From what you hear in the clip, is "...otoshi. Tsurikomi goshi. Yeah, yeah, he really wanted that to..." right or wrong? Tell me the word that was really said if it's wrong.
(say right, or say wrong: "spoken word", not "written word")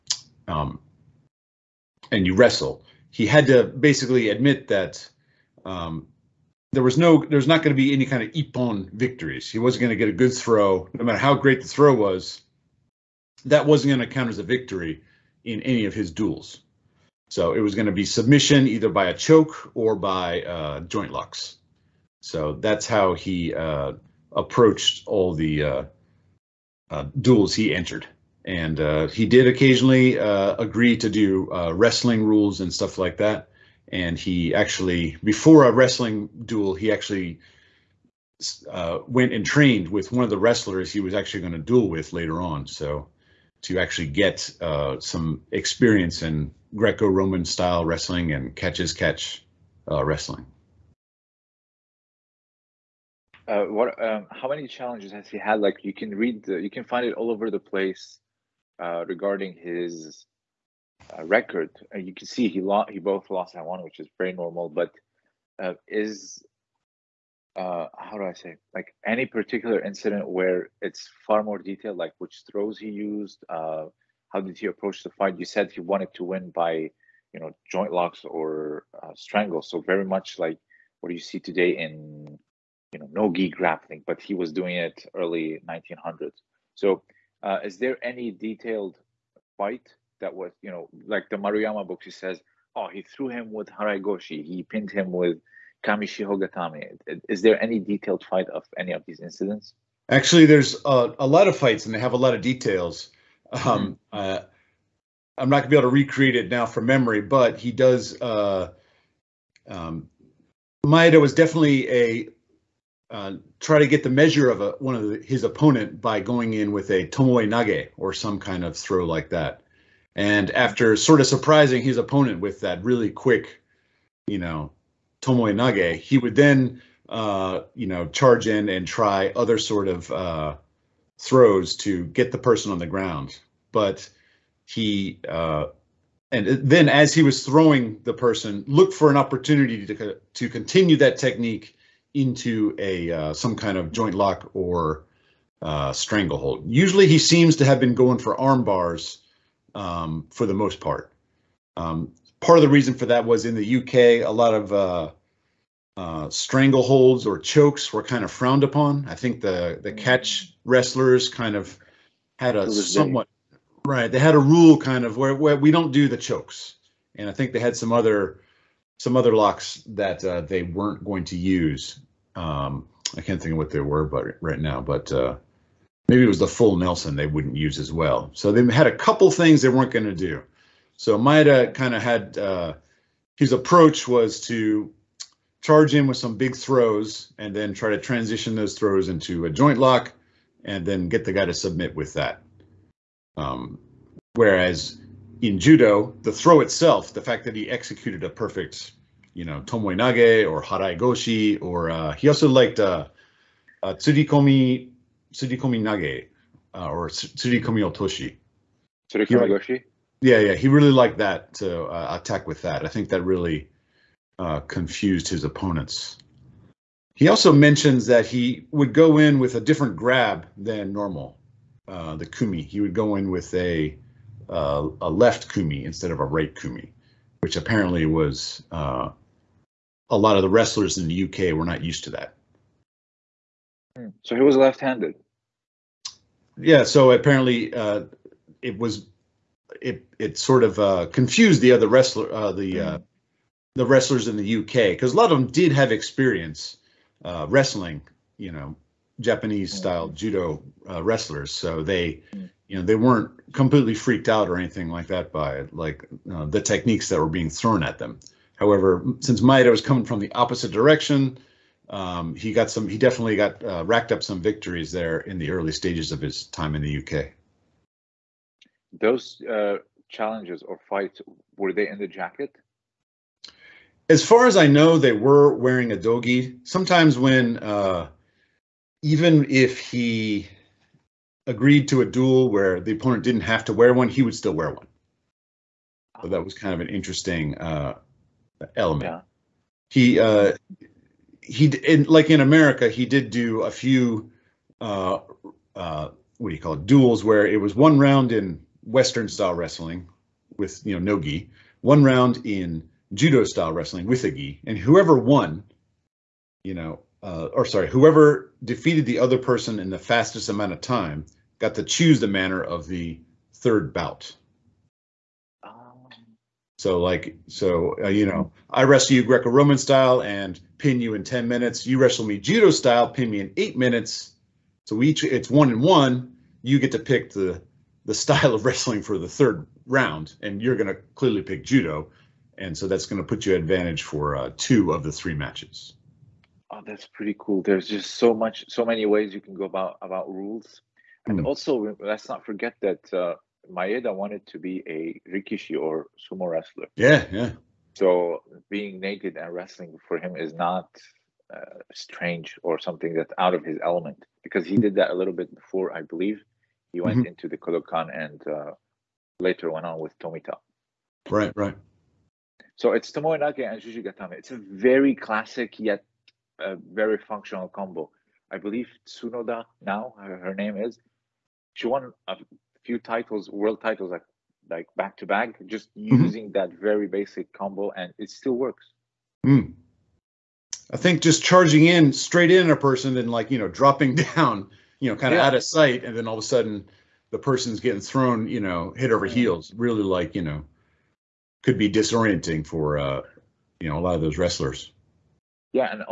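wrong: "liked", not "wanted".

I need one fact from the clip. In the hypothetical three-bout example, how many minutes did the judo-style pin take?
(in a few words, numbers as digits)
8.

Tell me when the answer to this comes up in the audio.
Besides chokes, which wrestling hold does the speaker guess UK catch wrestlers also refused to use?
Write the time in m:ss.
2:56.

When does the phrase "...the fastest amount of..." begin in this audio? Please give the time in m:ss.
5:09.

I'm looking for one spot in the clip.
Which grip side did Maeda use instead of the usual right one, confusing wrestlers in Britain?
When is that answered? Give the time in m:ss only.
3:45.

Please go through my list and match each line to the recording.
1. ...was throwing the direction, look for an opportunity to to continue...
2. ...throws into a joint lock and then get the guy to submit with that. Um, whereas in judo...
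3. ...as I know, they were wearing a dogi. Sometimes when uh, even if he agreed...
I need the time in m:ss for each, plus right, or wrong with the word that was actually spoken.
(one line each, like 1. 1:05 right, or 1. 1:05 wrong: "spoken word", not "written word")
1. 2:17 wrong: "person", not "direction"
2. 3:08 right
3. 4:34 right.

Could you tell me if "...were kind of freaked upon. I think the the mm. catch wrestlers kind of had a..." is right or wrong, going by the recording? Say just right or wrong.
wrong.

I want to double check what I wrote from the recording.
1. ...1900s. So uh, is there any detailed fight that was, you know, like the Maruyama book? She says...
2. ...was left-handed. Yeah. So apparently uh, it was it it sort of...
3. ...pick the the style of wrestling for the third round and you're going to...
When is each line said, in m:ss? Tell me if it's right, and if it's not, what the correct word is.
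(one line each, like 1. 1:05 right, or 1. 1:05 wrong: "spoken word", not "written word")
1. 1:25 right
2. 3:54 right
3. 5:26 right.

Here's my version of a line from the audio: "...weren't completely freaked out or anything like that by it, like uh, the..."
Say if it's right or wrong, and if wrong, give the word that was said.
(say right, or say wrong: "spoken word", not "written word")
right.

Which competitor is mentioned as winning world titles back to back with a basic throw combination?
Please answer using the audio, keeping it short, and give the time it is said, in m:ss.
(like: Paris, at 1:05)
Tsunoda, at 6:09.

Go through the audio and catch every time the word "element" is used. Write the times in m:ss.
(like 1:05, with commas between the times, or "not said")
4:48, 5:53.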